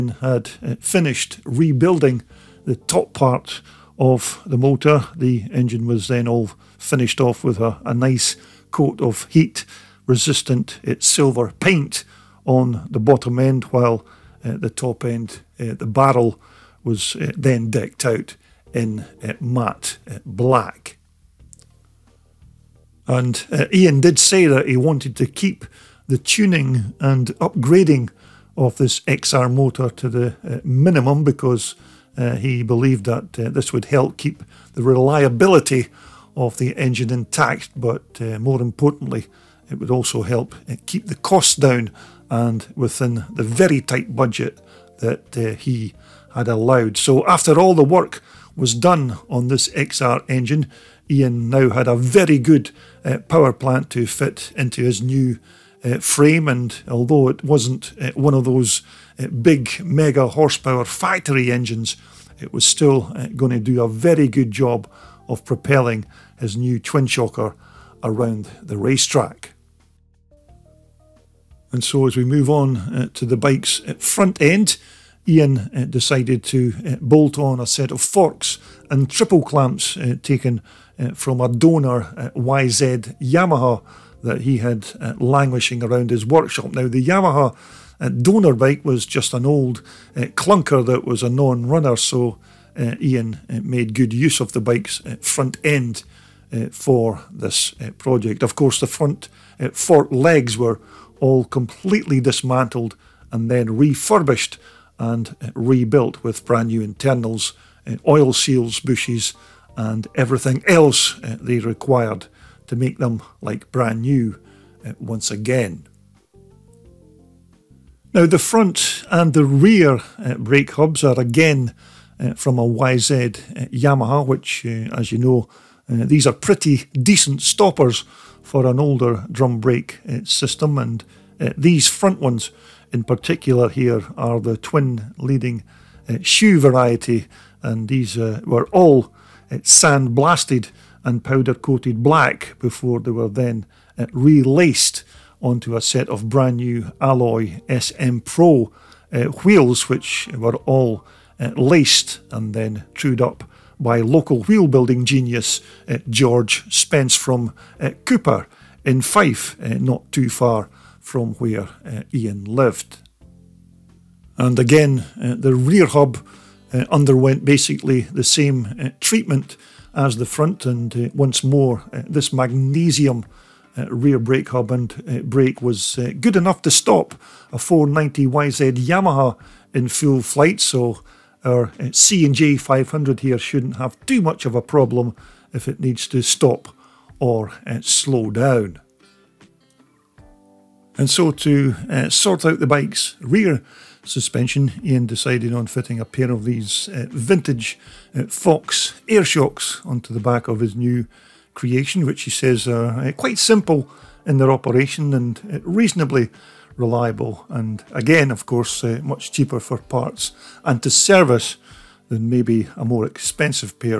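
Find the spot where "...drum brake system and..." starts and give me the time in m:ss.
2:09.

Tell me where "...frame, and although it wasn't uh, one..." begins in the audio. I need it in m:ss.
0:55.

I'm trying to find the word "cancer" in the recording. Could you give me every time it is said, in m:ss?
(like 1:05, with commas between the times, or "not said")
not said.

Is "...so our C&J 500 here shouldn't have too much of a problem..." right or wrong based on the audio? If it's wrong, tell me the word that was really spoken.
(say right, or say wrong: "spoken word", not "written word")
right.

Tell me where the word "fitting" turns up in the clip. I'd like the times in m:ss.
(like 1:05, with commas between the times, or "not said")
3:15.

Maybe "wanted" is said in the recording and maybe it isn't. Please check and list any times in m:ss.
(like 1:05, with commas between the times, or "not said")
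0:24.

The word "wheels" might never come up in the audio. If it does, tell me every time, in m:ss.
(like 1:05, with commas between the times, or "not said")
2:29, 2:34.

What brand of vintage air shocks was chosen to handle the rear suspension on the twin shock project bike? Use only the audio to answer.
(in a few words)
Fox.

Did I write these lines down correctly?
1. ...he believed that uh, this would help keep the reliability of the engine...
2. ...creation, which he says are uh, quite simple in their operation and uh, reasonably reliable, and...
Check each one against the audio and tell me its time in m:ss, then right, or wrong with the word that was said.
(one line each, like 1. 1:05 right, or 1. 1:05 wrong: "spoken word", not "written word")
1. 0:32 right
2. 3:21 right.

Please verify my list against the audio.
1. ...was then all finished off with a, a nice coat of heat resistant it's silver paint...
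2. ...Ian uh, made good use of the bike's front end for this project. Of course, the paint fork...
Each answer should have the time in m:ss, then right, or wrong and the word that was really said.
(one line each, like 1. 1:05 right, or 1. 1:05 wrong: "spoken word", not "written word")
1. 0:05 right
2. 1:33 wrong: "front", not "paint".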